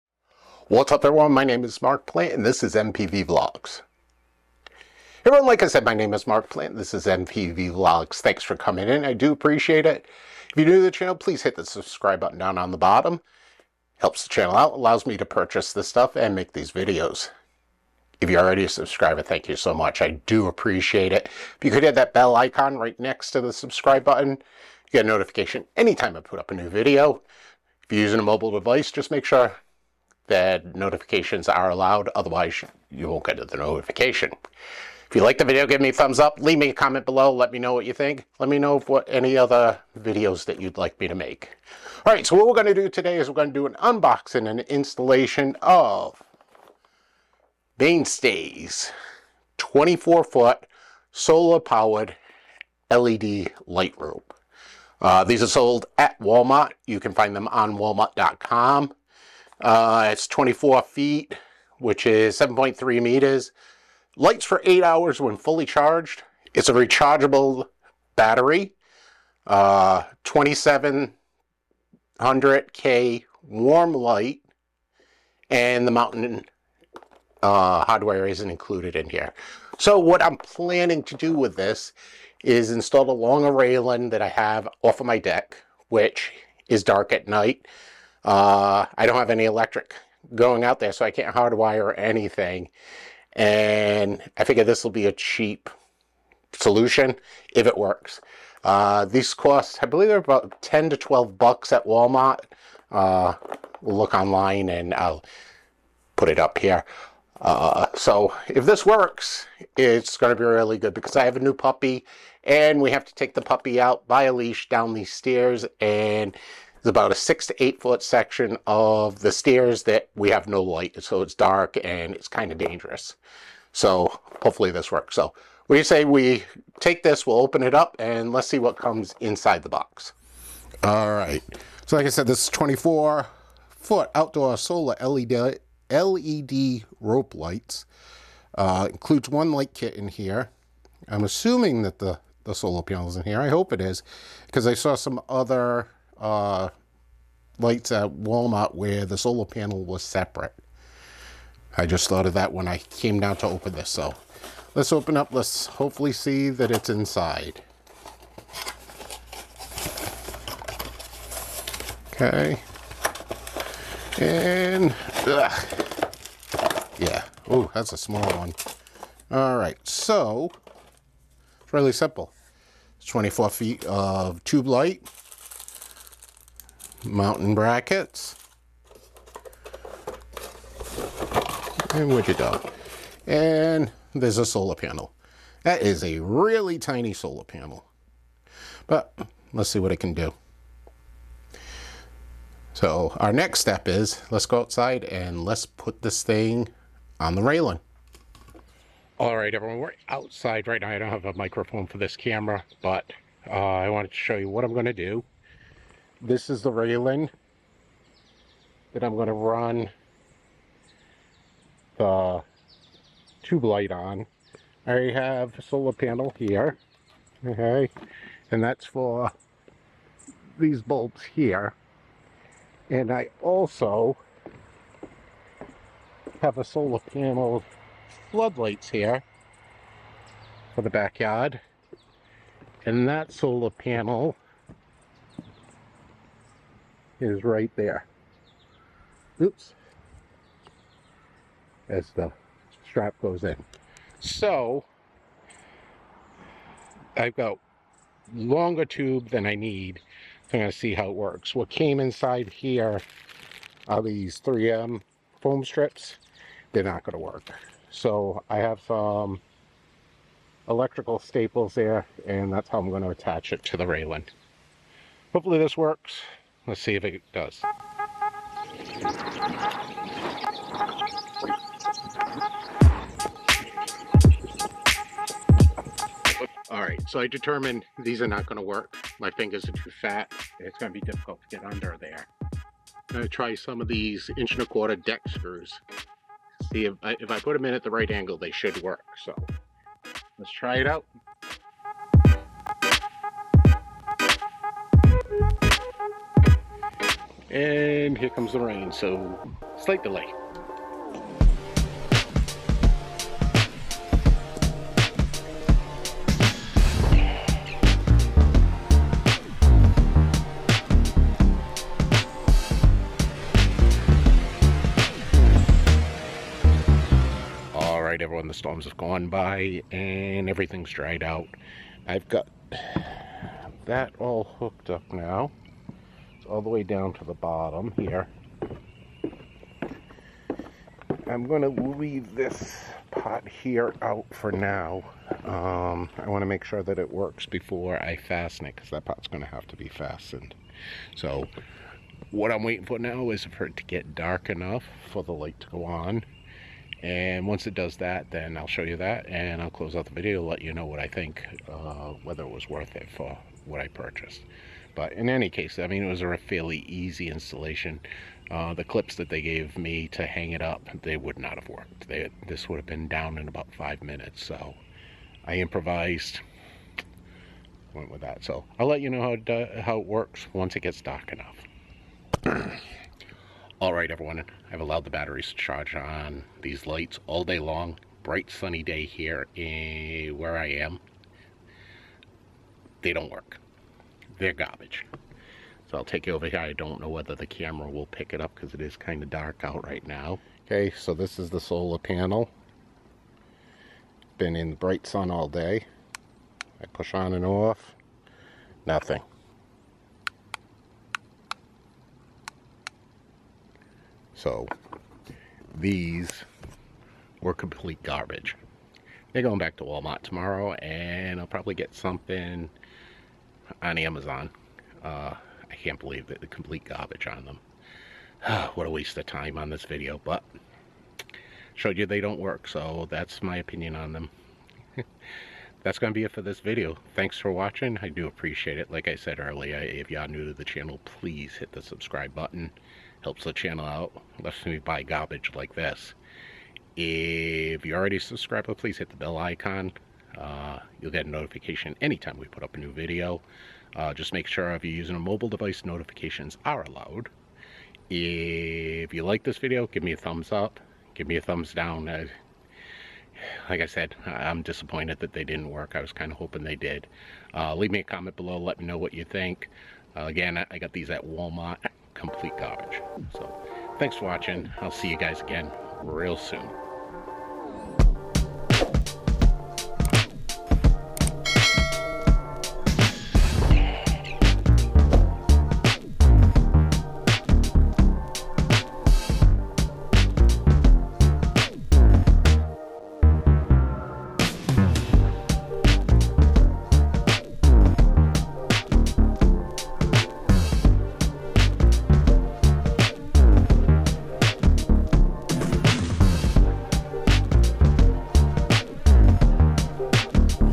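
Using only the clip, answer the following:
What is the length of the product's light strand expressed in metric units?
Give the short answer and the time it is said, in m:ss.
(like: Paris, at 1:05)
7.3 meters, at 1:02.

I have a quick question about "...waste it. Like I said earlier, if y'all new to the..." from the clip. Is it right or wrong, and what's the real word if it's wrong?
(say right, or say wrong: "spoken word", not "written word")
wrong: "appreciate", not "waste".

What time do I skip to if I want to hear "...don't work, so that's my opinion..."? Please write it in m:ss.
7:02.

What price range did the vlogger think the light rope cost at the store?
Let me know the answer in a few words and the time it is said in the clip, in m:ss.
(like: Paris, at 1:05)
10 to 12 bucks, at 1:40.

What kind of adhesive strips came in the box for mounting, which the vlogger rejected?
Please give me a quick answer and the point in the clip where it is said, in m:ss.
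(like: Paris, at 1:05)
3M foam strips, at 4:14.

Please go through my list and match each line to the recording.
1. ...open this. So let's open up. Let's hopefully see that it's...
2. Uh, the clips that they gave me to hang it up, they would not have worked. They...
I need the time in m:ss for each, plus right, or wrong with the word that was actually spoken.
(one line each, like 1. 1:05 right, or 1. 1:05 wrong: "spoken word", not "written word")
1. 2:33 right
2. 5:58 right.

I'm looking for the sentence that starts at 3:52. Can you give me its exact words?
And that solar panel is right there.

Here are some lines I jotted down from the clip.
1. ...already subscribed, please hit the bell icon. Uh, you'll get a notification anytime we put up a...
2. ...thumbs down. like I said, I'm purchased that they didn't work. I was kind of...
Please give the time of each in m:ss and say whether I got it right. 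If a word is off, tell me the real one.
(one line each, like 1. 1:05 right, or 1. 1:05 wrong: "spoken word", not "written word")
1. 7:17 right
2. 7:31 wrong: "disappointed", not "purchased".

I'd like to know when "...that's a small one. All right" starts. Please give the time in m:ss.
2:47.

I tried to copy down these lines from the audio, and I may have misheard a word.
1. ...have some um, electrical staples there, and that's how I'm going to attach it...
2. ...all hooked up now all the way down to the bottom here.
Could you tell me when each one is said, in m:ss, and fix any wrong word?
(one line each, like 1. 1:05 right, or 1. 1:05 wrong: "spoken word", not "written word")
1. 4:18 right
2. 5:24 right.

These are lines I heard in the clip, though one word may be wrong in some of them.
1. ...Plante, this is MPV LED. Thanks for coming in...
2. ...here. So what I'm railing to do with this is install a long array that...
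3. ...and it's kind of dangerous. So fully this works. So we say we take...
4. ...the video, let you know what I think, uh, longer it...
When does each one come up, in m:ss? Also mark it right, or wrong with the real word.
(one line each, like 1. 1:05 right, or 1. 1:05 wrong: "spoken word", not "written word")
1. 0:06 wrong: "Vlogs", not "LED"
2. 1:19 wrong: "planning", not "railing"
3. 2:01 wrong: "hopefully", not "fully"
4. 5:50 wrong: "whether", not "longer".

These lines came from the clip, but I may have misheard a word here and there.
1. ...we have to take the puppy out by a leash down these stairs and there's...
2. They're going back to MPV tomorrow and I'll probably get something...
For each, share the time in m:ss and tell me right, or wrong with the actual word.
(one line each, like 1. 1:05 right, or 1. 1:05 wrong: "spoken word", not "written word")
1. 1:52 right
2. 6:49 wrong: "Walmart", not "MPV".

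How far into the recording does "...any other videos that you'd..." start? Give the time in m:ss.
0:39.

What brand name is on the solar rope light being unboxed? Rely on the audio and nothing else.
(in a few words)
Mainstays.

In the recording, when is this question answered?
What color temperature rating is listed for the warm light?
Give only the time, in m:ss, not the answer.
1:10.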